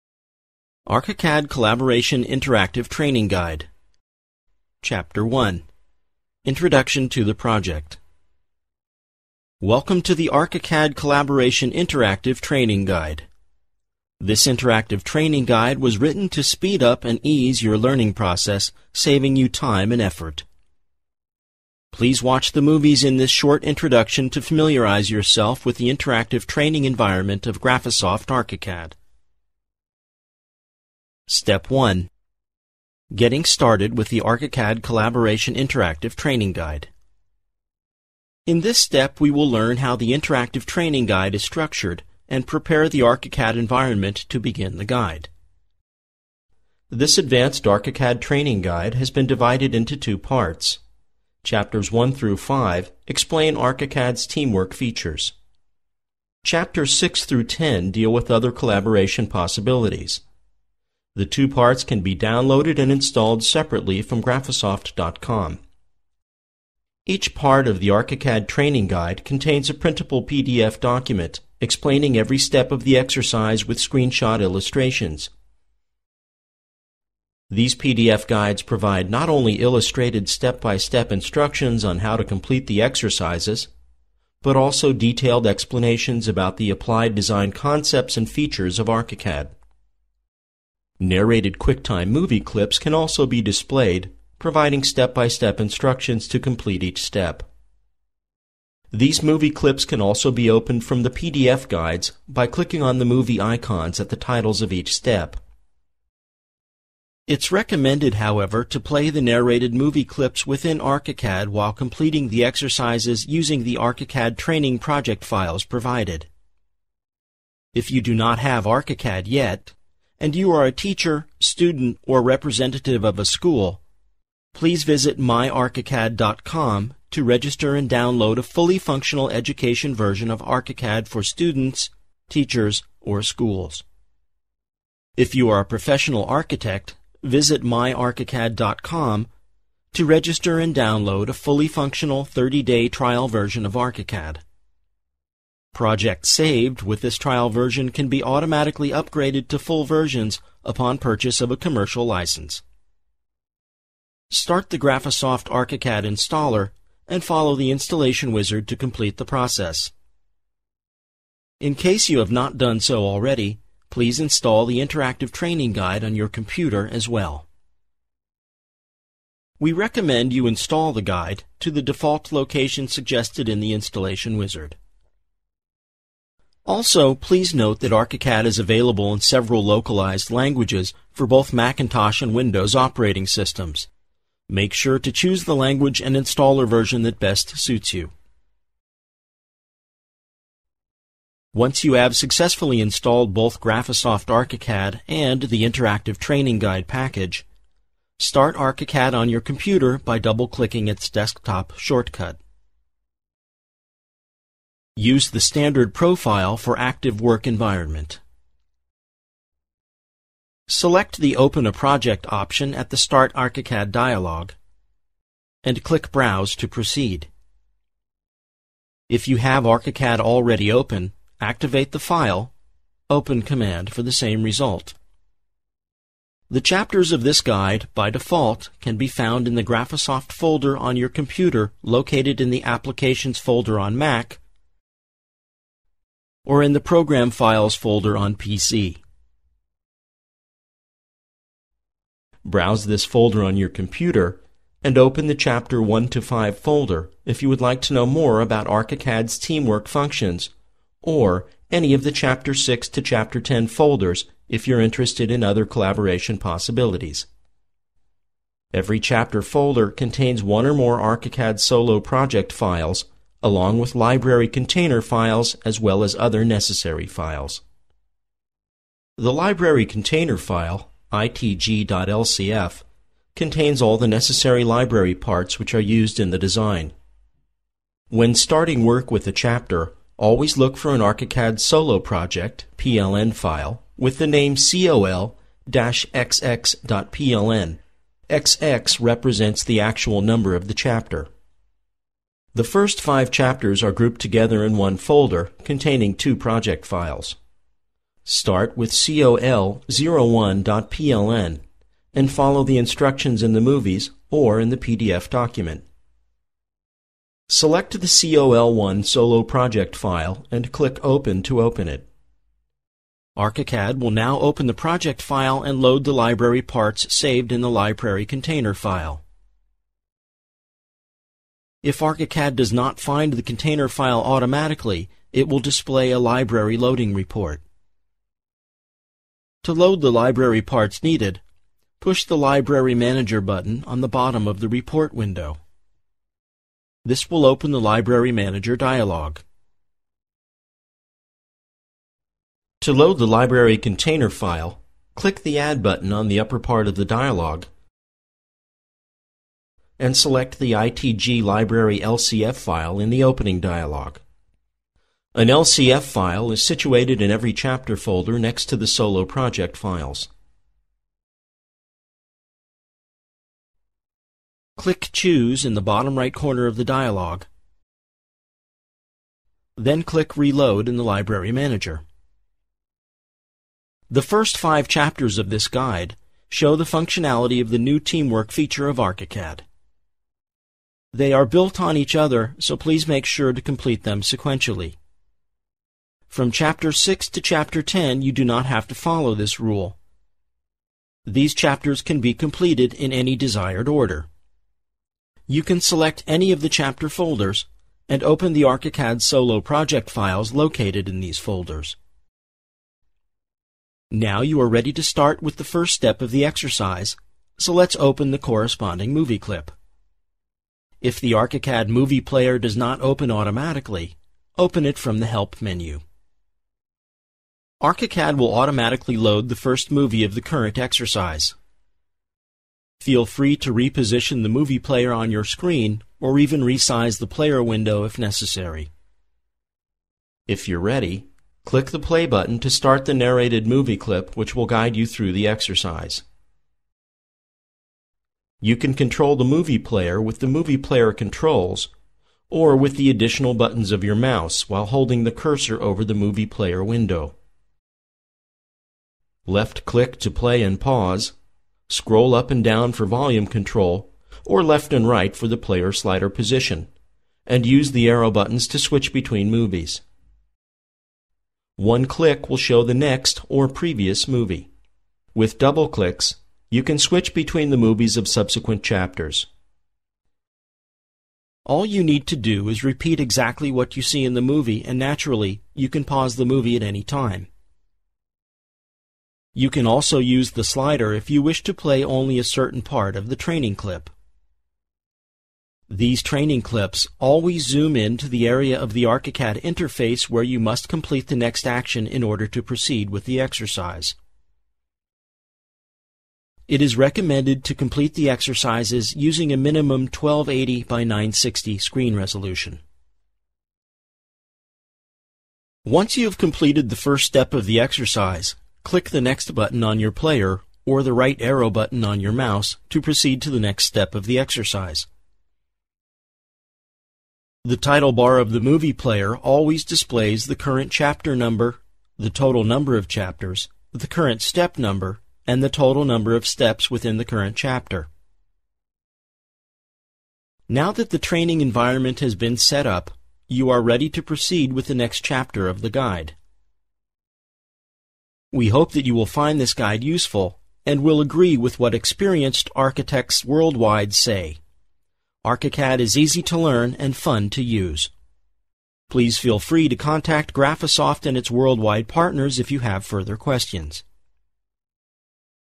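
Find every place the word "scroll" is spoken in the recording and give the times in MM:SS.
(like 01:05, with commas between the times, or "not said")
07:31.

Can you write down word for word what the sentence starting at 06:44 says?
Now you are ready to start with the first step of the exercise, so let's open the corresponding movie clip.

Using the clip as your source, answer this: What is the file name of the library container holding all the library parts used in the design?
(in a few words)
itg.lcf.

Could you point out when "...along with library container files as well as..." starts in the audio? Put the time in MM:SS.
04:23.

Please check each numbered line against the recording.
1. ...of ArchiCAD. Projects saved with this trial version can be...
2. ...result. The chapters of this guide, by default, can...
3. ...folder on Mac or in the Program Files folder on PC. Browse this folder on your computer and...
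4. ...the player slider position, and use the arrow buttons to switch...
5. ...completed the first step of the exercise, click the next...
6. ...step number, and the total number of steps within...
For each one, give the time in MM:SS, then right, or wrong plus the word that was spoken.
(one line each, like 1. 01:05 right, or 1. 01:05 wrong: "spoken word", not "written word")
1. 02:23 right
2. 03:44 right
3. 03:53 right
4. 07:35 right
5. 08:26 right
6. 08:44 right.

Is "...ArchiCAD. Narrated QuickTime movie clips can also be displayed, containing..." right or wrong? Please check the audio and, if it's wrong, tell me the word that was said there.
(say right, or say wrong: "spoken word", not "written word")
wrong: "providing", not "containing".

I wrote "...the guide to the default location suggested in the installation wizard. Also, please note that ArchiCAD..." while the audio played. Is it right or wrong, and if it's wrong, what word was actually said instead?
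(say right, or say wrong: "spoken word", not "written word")
right.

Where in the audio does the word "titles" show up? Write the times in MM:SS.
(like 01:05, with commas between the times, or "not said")
01:44, 08:37.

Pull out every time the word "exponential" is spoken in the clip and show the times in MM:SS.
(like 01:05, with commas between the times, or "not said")
not said.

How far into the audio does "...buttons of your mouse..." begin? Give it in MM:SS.
07:23.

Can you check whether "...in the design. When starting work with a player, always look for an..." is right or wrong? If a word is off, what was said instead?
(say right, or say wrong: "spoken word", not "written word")
wrong: "chapter", not "player".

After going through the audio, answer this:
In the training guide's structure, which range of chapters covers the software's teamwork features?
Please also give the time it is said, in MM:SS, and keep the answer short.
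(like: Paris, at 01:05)
Chapters 1 through 5, at 00:51.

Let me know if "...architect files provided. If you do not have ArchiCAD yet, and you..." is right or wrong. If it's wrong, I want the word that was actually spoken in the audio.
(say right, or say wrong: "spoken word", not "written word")
wrong: "project", not "architect".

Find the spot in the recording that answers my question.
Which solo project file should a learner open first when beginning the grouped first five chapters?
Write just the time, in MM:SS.
04:58.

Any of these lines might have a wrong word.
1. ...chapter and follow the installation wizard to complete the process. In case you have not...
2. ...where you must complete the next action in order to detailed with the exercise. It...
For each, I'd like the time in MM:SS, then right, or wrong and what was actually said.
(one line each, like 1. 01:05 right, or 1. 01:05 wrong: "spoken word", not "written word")
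1. 02:36 wrong: "installer", not "chapter"
2. 08:10 wrong: "proceed", not "detailed".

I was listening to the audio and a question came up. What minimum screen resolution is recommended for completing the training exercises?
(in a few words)
1280 by 960.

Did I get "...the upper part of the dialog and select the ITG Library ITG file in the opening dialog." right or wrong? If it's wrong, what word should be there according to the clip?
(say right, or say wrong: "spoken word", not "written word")
wrong: "LCF", not "ITG".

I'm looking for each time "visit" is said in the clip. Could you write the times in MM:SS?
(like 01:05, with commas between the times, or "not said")
02:04, 02:17.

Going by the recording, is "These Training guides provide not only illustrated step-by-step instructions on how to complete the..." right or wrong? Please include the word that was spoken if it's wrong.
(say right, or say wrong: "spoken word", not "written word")
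wrong: "PDF", not "Training".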